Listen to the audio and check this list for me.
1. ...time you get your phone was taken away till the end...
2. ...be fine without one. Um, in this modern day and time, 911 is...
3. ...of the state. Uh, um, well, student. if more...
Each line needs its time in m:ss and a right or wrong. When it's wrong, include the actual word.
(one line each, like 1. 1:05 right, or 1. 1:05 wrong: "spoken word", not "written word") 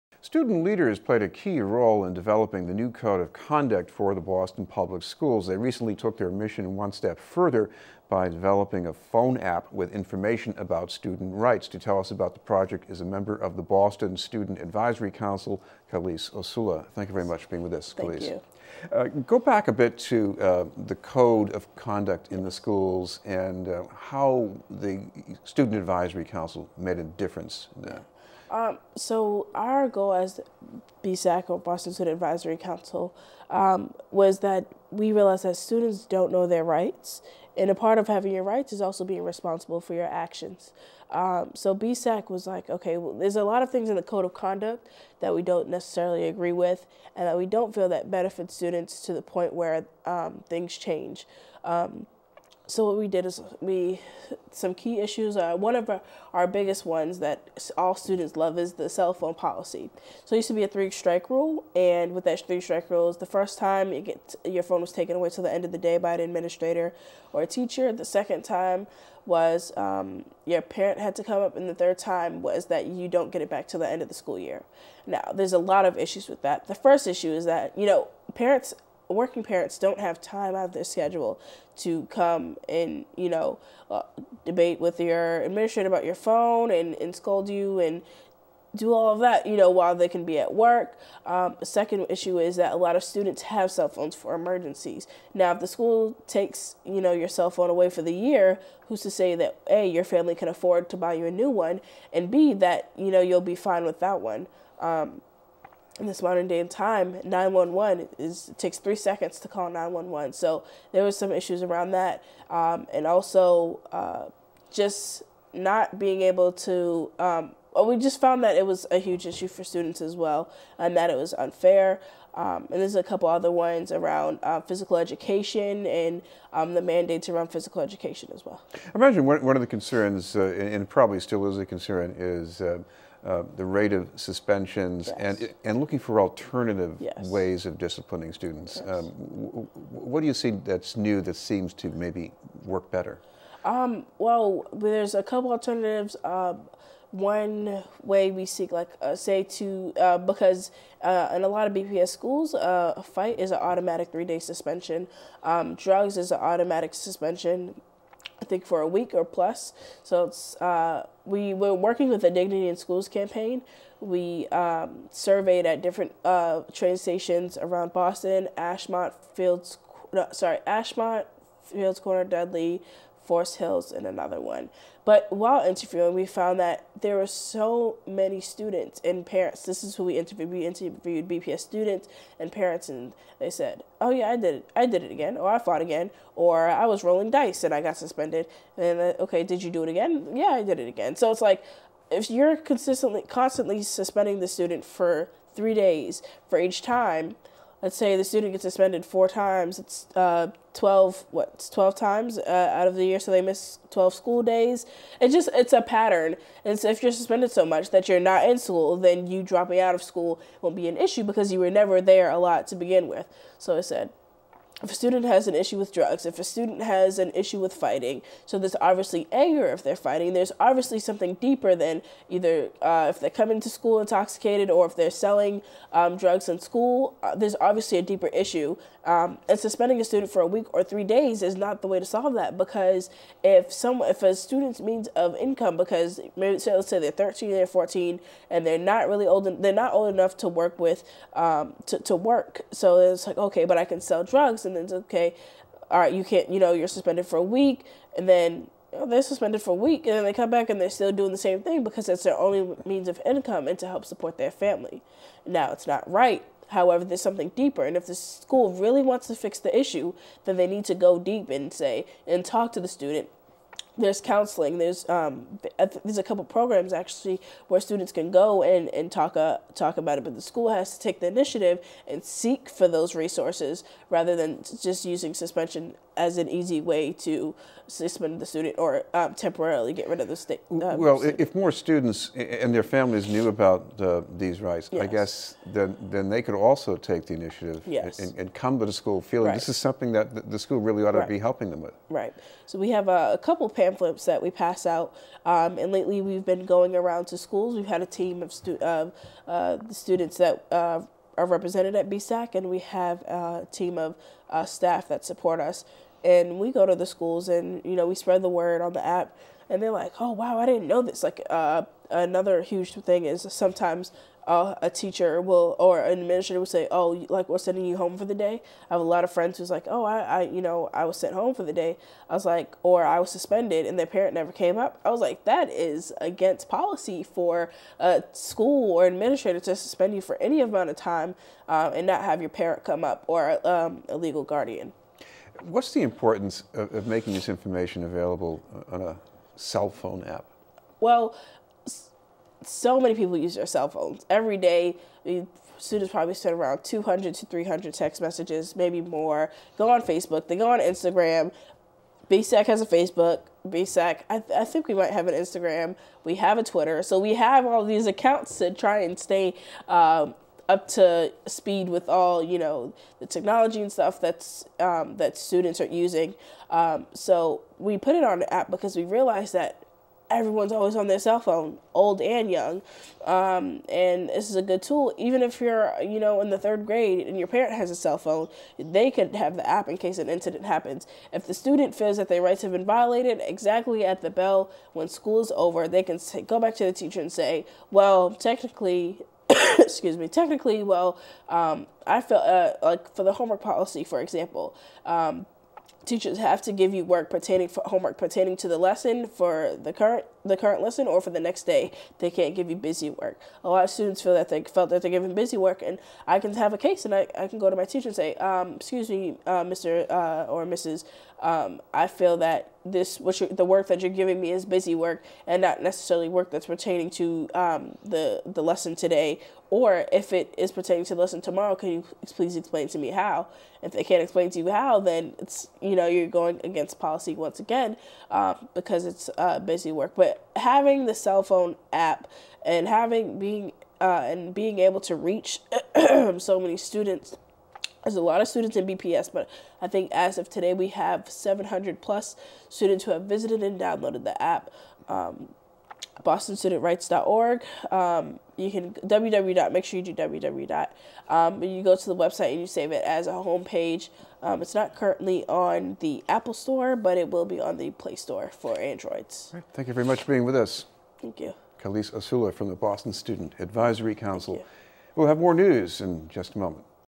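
1. 1:03 right
2. 1:43 right
3. 4:40 right.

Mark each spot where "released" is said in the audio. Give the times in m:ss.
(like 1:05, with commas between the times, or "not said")
not said.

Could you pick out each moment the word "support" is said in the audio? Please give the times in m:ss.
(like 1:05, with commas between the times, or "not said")
4:14, 5:05.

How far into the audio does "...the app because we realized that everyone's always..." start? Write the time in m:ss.
6:08.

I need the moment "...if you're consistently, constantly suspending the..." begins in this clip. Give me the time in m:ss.
3:12.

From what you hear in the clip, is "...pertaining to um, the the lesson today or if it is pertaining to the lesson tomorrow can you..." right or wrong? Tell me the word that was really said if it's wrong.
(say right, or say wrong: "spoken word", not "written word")
right.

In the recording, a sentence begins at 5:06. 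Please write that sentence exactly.
And we go to the schools, and you know, we spread the word on the app.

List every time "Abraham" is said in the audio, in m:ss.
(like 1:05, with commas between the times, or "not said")
not said.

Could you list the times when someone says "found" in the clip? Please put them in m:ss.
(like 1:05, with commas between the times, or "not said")
1:58, 2:56.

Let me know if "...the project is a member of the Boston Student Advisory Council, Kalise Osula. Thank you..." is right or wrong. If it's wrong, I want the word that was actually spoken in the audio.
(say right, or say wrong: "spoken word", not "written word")
right.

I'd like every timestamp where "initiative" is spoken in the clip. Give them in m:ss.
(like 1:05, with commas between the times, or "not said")
4:31, 4:47.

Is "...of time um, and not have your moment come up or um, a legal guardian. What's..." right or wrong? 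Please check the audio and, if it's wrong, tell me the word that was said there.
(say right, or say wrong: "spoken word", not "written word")
wrong: "parent", not "moment".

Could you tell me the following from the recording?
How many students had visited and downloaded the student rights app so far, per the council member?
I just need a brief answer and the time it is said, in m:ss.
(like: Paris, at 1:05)
700+, at 7:21.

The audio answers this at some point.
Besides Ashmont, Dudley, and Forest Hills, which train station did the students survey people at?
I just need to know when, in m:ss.
2:51.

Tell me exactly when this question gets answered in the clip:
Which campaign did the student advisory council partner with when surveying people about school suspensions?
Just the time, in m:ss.
2:42.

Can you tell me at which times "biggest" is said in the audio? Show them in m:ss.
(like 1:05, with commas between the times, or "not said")
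0:56.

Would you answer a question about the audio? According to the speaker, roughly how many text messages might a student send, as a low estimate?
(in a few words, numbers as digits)
200.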